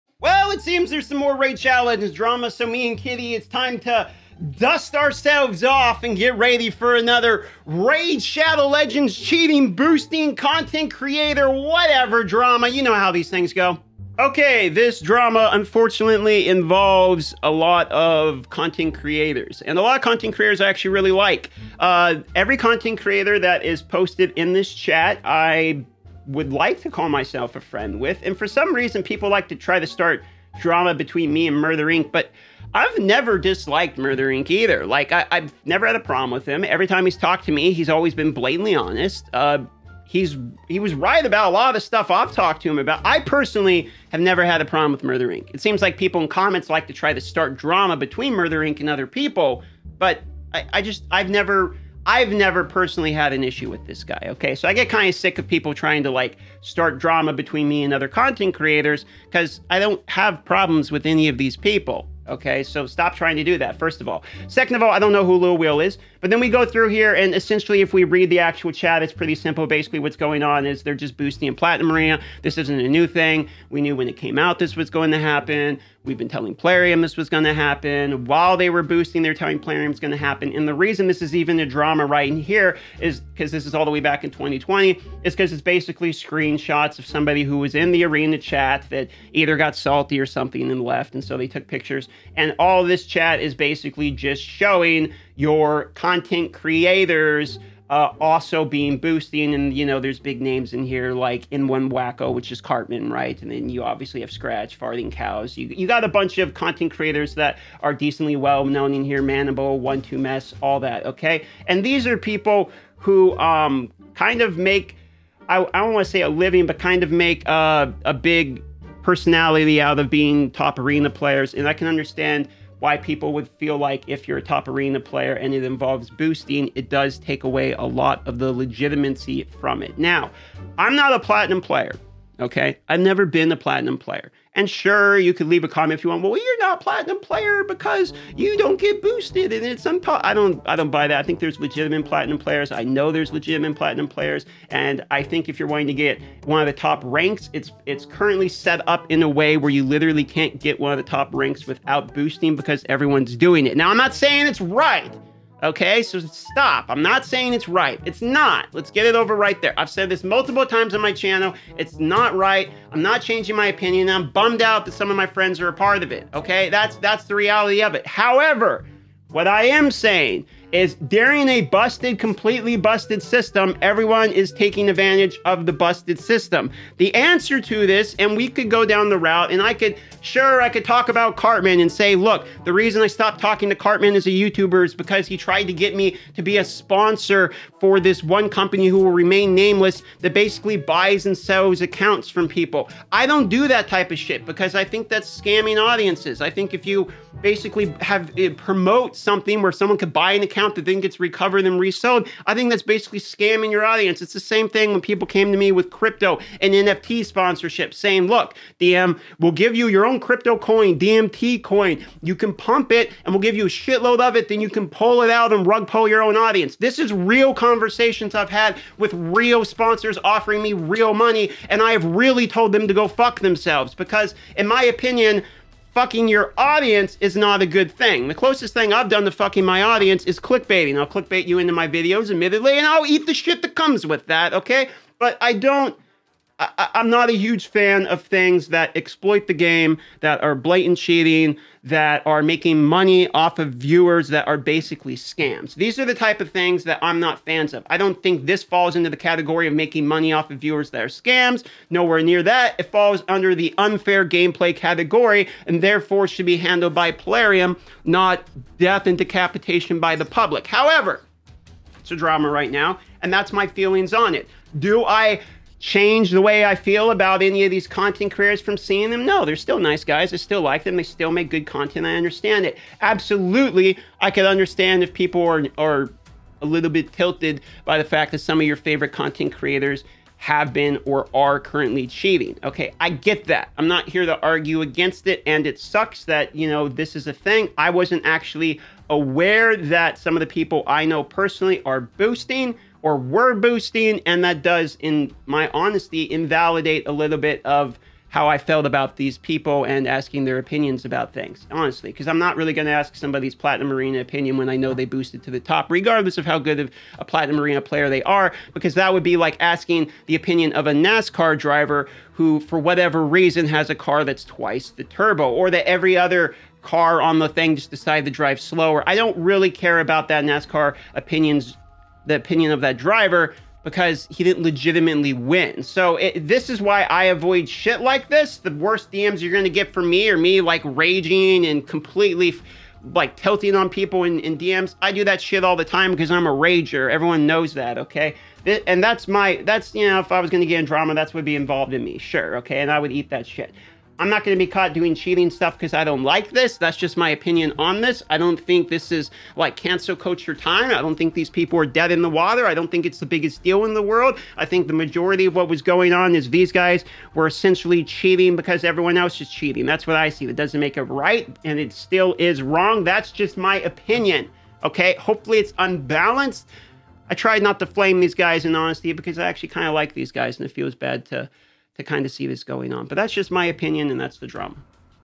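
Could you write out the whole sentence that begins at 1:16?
We've been telling Plarium this was going to happen.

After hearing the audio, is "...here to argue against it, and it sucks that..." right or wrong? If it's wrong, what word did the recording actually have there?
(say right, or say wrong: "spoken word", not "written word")
right.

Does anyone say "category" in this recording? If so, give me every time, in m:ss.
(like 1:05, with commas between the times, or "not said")
4:09, 4:14.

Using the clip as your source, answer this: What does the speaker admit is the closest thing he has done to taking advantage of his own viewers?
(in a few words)
Clickbaiting.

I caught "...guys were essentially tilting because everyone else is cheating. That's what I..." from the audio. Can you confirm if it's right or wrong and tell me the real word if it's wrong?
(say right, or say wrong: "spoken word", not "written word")
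wrong: "cheating", not "tilting".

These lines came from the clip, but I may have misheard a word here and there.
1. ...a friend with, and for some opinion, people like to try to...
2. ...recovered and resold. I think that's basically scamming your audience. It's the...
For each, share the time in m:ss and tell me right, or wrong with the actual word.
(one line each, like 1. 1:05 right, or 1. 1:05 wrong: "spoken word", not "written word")
1. 0:27 wrong: "reason", not "opinion"
2. 3:21 right.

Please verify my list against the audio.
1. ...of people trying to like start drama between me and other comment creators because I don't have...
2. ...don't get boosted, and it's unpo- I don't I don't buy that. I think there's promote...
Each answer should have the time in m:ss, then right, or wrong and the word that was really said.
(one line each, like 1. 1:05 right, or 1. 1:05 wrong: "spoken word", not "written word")
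1. 0:55 wrong: "content", not "comment"
2. 2:18 wrong: "legitimate", not "promote".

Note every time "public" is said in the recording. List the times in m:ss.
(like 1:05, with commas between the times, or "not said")
4:20.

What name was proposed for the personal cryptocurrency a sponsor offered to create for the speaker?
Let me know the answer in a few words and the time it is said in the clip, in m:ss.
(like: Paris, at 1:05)
DMT coin, at 3:30.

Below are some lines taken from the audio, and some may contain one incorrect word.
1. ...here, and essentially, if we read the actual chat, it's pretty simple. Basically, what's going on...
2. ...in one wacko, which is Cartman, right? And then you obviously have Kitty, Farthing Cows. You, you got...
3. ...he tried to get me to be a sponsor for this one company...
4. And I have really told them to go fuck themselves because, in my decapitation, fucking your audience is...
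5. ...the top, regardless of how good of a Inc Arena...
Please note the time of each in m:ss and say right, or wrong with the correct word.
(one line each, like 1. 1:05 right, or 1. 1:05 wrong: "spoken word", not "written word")
1. 1:06 right
2. 1:41 wrong: "Scratch", not "Kitty"
3. 3:05 right
4. 3:41 wrong: "opinion", not "decapitation"
5. 5:05 wrong: "Platinum", not "Inc".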